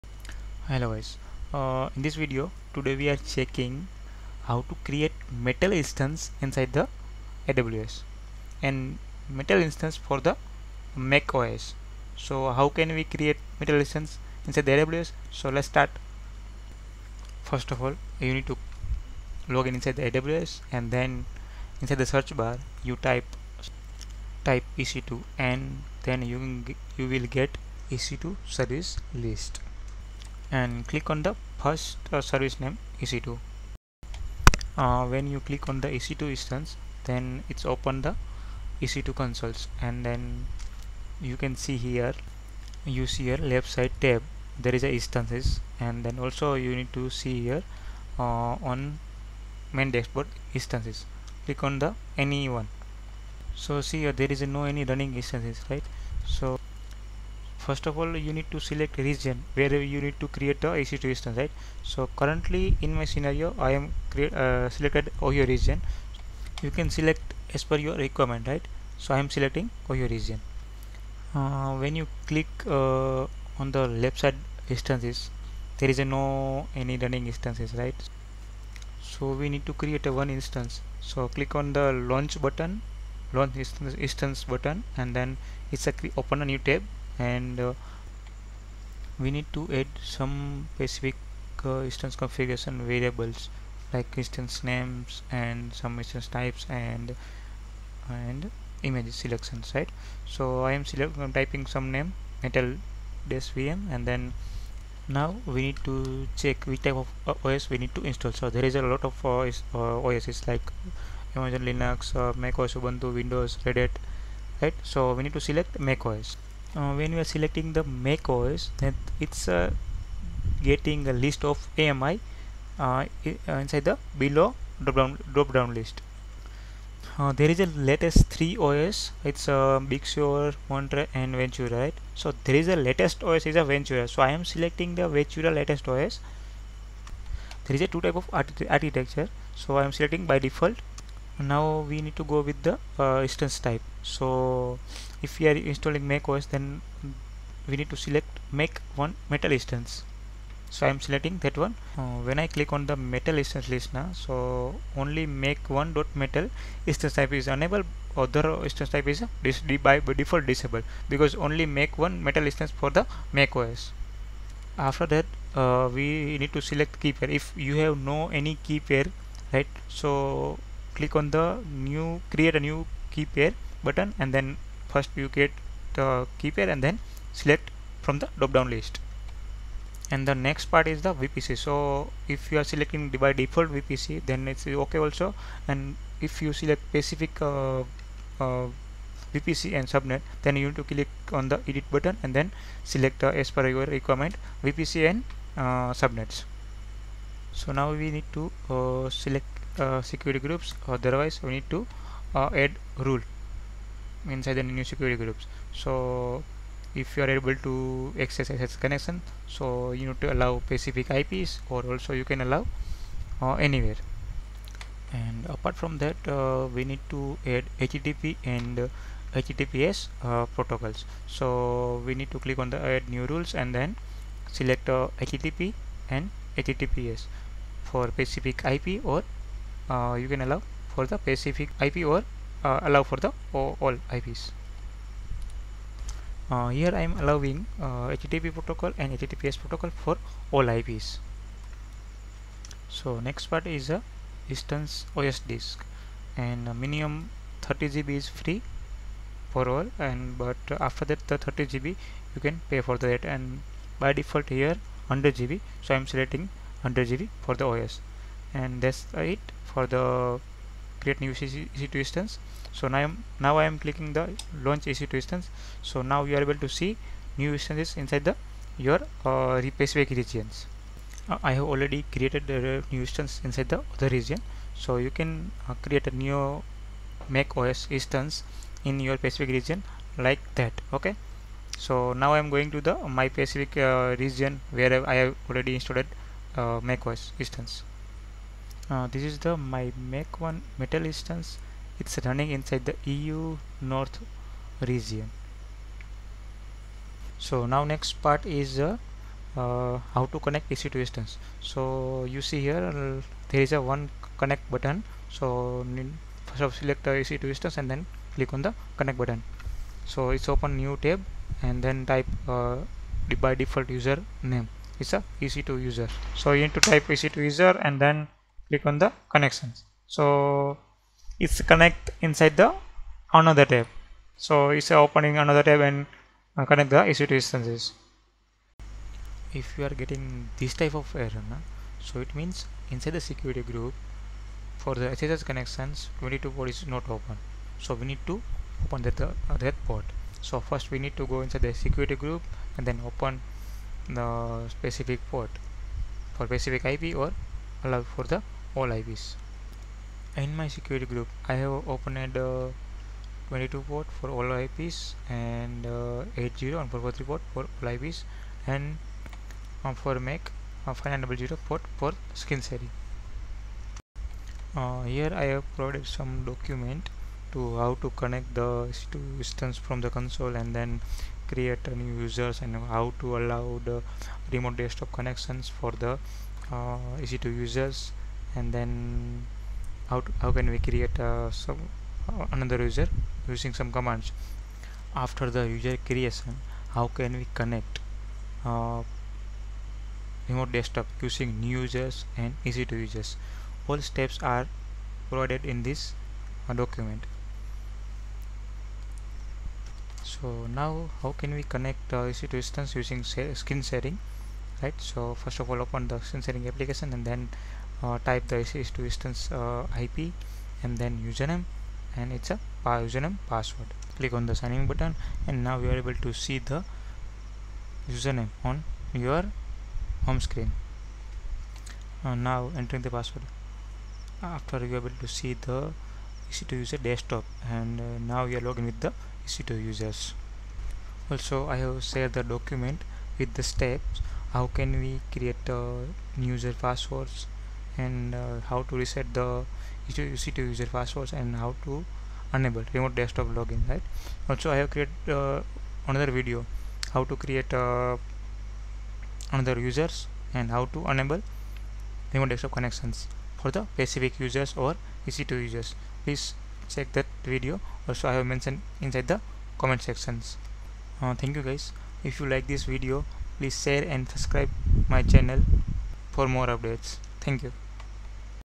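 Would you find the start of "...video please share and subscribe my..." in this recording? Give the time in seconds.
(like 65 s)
462 s.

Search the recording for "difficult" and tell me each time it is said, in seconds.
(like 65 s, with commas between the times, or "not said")
not said.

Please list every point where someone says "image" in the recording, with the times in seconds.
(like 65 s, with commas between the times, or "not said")
98 s.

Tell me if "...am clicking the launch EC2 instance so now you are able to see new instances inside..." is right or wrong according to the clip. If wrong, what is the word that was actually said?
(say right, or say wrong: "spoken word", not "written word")
right.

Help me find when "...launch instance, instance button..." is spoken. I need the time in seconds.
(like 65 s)
83 s.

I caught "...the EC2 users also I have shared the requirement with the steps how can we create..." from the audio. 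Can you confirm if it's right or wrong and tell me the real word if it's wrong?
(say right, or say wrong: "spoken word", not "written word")
wrong: "document", not "requirement".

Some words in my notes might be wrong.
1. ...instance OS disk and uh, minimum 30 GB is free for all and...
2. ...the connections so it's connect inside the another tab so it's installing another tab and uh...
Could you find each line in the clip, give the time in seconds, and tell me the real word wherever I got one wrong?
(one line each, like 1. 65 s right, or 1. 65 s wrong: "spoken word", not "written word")
1. 244 s right
2. 319 s wrong: "opening", not "installing".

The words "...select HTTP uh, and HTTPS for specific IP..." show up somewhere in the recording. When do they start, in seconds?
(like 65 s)
224 s.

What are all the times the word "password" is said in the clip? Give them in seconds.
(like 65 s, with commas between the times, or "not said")
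413 s, 423 s, 436 s, 440 s.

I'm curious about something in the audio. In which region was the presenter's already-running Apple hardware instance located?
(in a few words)
EU North.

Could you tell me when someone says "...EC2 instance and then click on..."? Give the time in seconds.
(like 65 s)
307 s.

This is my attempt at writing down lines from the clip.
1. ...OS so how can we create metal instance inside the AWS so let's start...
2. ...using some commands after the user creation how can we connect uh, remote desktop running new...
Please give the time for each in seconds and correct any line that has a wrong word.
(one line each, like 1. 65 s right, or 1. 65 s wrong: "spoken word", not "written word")
1. 11 s right
2. 383 s wrong: "using", not "running".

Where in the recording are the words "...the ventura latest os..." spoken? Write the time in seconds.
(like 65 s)
135 s.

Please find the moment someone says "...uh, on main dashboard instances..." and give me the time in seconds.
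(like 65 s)
48 s.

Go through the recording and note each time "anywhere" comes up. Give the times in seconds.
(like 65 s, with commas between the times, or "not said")
213 s.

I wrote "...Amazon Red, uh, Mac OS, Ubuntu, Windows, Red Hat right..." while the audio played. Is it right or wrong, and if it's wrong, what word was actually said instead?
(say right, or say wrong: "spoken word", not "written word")
wrong: "Linux", not "Red".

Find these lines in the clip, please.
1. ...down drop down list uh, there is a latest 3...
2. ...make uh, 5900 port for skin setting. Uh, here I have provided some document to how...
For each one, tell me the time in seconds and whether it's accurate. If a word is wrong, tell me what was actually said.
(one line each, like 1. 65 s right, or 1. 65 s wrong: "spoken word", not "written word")
1. 125 s right
2. 360 s right.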